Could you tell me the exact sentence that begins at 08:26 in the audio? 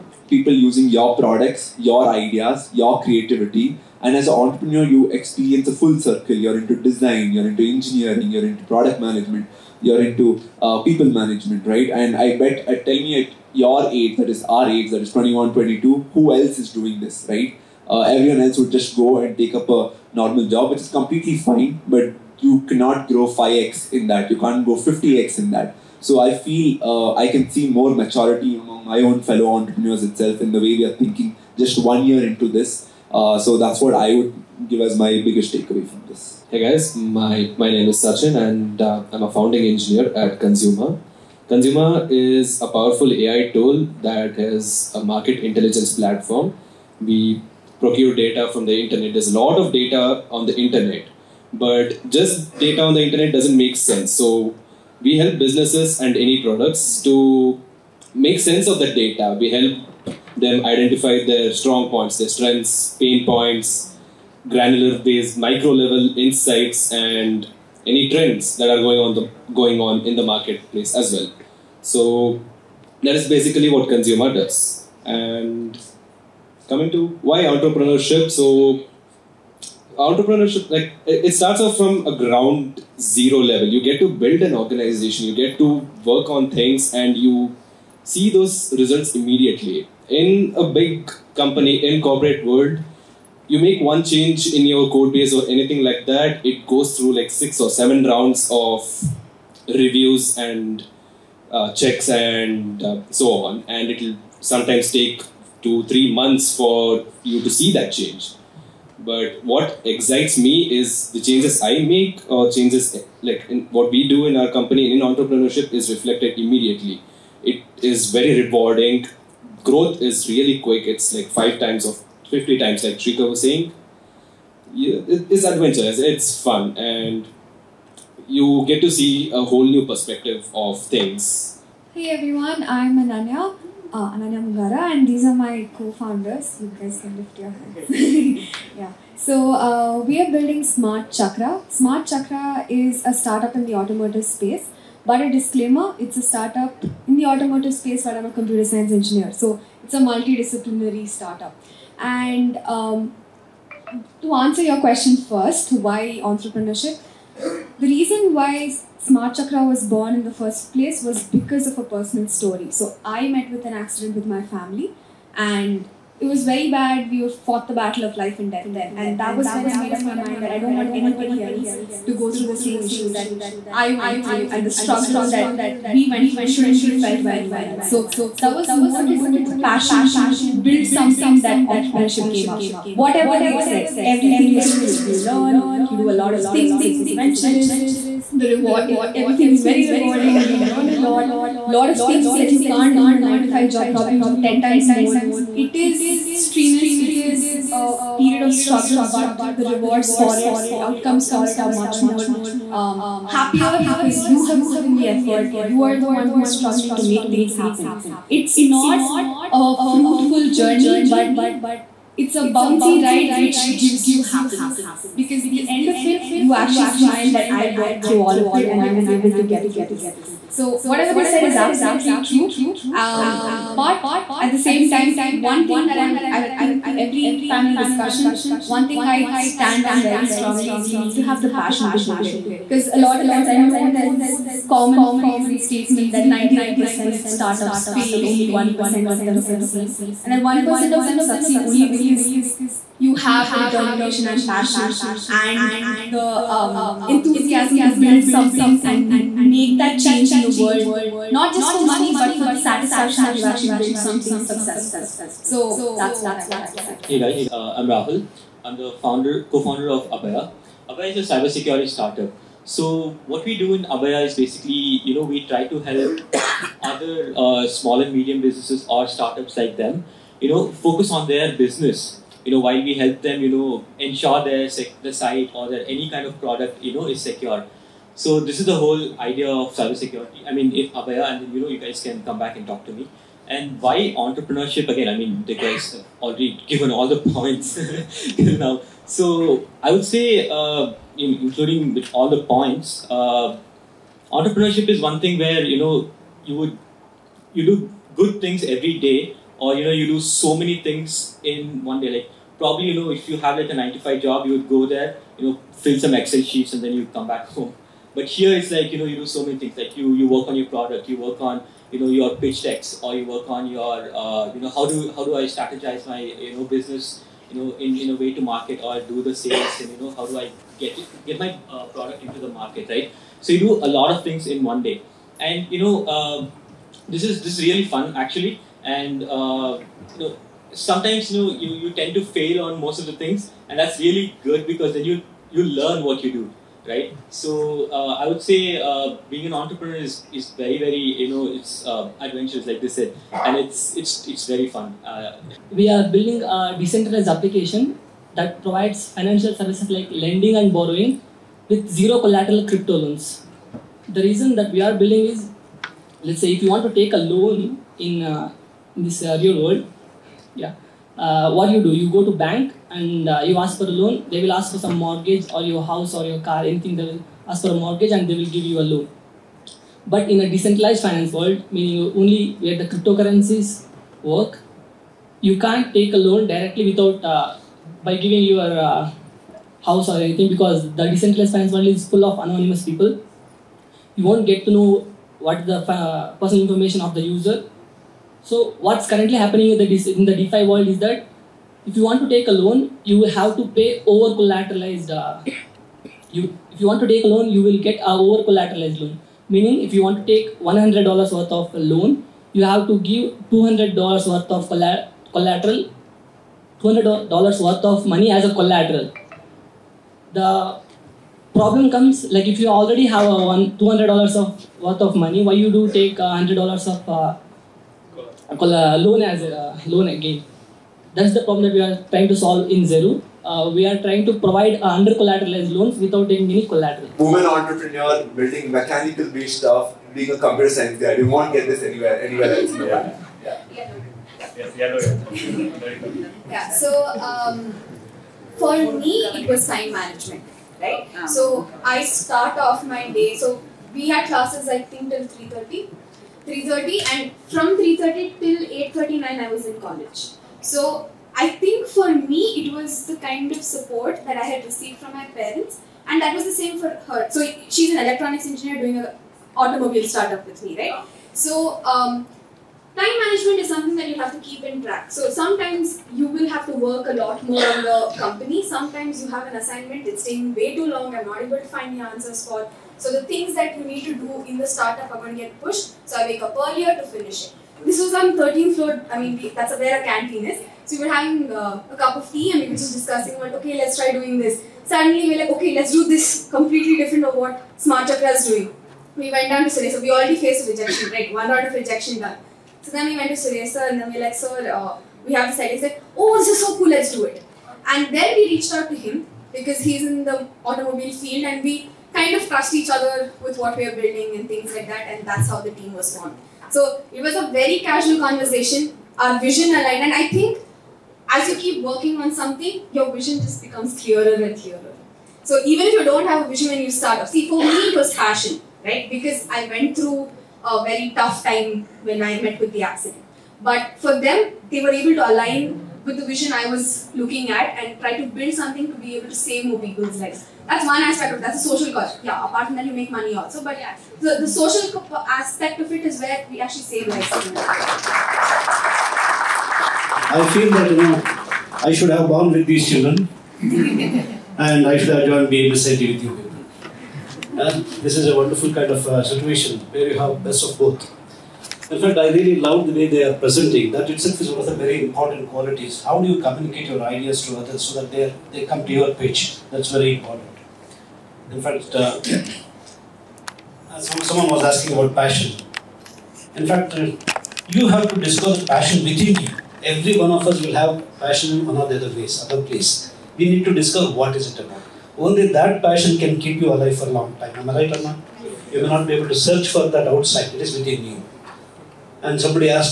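So it was a very casual conversation.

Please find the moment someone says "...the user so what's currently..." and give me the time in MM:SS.
06:27.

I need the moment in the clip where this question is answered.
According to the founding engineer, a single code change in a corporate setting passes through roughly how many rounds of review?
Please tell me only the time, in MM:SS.
01:37.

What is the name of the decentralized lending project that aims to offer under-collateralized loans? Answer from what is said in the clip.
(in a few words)
Zeru.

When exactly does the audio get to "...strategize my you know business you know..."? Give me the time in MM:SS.
05:15.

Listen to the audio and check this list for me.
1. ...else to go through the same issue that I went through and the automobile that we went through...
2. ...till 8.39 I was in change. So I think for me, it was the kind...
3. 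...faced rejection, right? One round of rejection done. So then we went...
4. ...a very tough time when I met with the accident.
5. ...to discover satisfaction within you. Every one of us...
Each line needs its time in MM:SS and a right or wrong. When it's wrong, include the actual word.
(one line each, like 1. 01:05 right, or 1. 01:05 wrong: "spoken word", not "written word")
1. 02:51 wrong: "struggle", not "automobile"
2. 07:28 wrong: "college", not "change"
3. 08:10 right
4. 08:40 right
5. 09:28 wrong: "passion", not "satisfaction".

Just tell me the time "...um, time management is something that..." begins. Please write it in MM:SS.
07:41.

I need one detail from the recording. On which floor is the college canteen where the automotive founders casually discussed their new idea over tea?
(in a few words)
13th.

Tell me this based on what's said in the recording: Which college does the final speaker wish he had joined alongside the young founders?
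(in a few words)
BMSIT.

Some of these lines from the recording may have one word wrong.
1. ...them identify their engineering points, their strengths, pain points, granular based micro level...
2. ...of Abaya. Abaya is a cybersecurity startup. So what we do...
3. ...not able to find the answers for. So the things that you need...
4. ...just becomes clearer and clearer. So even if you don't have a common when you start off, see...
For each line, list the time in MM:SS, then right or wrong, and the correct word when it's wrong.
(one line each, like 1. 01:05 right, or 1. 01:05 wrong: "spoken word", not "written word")
1. 01:00 wrong: "strong", not "engineering"
2. 04:19 right
3. 07:51 right
4. 08:33 wrong: "vision", not "common".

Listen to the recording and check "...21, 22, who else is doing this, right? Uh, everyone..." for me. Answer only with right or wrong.
right.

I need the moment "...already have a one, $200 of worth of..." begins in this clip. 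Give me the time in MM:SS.
06:52.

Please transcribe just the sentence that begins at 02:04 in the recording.
It's adventurous, it's fun, and you get to see a whole new perspective of things.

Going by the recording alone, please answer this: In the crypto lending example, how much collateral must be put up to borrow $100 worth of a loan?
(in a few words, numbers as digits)
$200.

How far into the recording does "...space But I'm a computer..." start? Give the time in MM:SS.
02:27.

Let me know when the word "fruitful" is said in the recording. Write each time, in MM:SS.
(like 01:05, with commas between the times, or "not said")
03:29.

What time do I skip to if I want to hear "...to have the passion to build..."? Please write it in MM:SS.
03:51.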